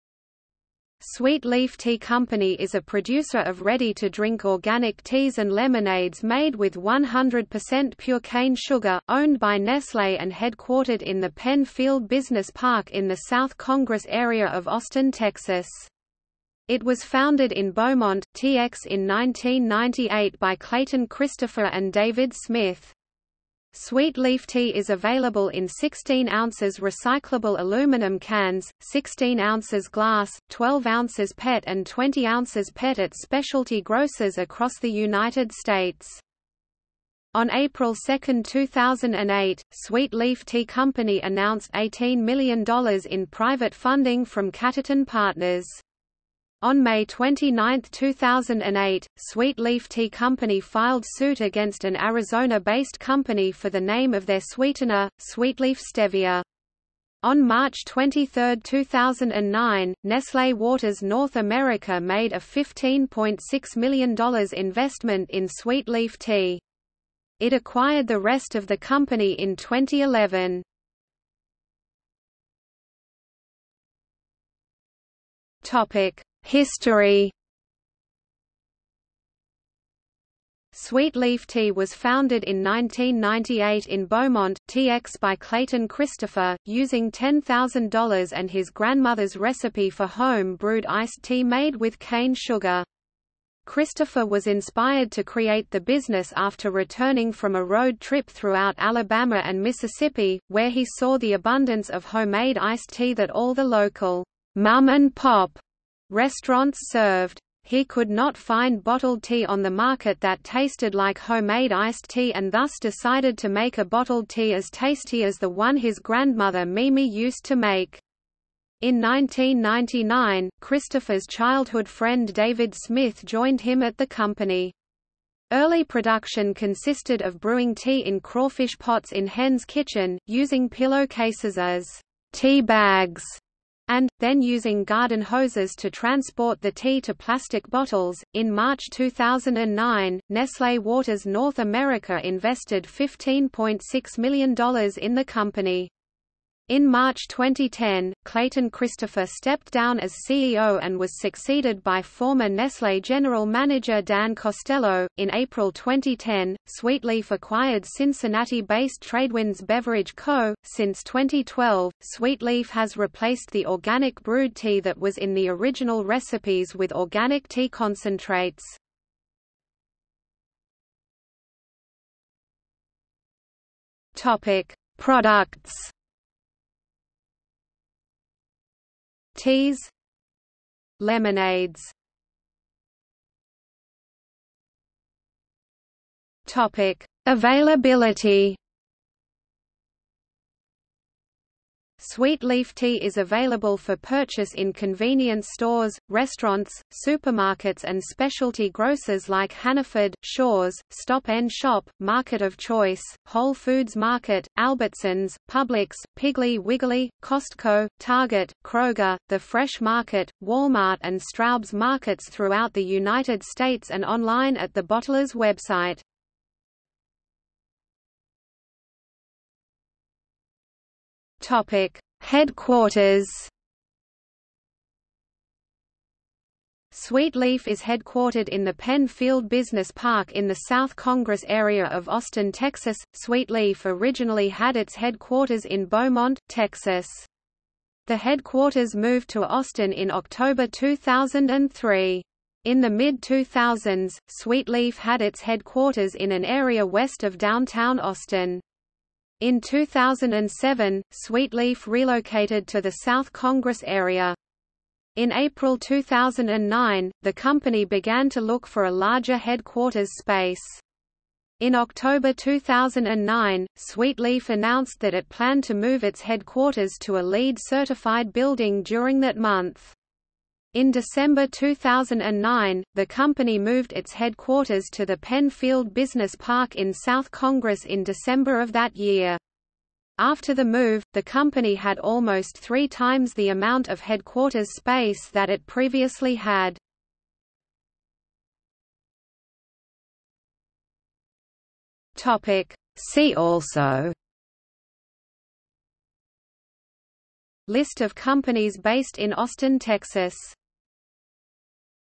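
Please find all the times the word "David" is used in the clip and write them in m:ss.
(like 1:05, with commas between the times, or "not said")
0:21, 2:02.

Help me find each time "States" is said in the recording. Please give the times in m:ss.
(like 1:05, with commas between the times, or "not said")
0:35, 3:33.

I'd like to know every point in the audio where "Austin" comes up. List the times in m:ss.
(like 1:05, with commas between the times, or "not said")
0:14, 3:52, 3:59, 4:07, 4:59.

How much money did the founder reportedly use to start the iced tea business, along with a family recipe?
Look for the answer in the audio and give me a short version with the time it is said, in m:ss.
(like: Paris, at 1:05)
$10,000, at 1:27.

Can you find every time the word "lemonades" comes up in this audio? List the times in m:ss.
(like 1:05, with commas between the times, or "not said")
0:05, 3:00.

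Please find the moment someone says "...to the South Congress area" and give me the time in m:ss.
4:12.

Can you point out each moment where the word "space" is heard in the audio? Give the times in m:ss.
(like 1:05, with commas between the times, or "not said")
4:20, 4:44.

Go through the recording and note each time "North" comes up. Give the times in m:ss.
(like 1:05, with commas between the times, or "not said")
1:01, 2:21.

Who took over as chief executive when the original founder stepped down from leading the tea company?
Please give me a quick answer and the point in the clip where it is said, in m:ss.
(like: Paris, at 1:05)
Dan Costello, at 2:34.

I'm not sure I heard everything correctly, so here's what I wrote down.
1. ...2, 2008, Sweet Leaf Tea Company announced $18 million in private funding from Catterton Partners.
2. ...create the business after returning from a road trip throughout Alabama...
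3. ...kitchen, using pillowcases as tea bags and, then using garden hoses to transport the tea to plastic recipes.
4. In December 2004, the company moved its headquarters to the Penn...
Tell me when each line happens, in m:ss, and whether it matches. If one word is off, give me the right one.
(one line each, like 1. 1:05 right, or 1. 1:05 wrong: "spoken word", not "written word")
1. 0:37 right
2. 1:35 right
3. 2:09 wrong: "bottles", not "recipes"
4. 4:30 wrong: "2009", not "2004".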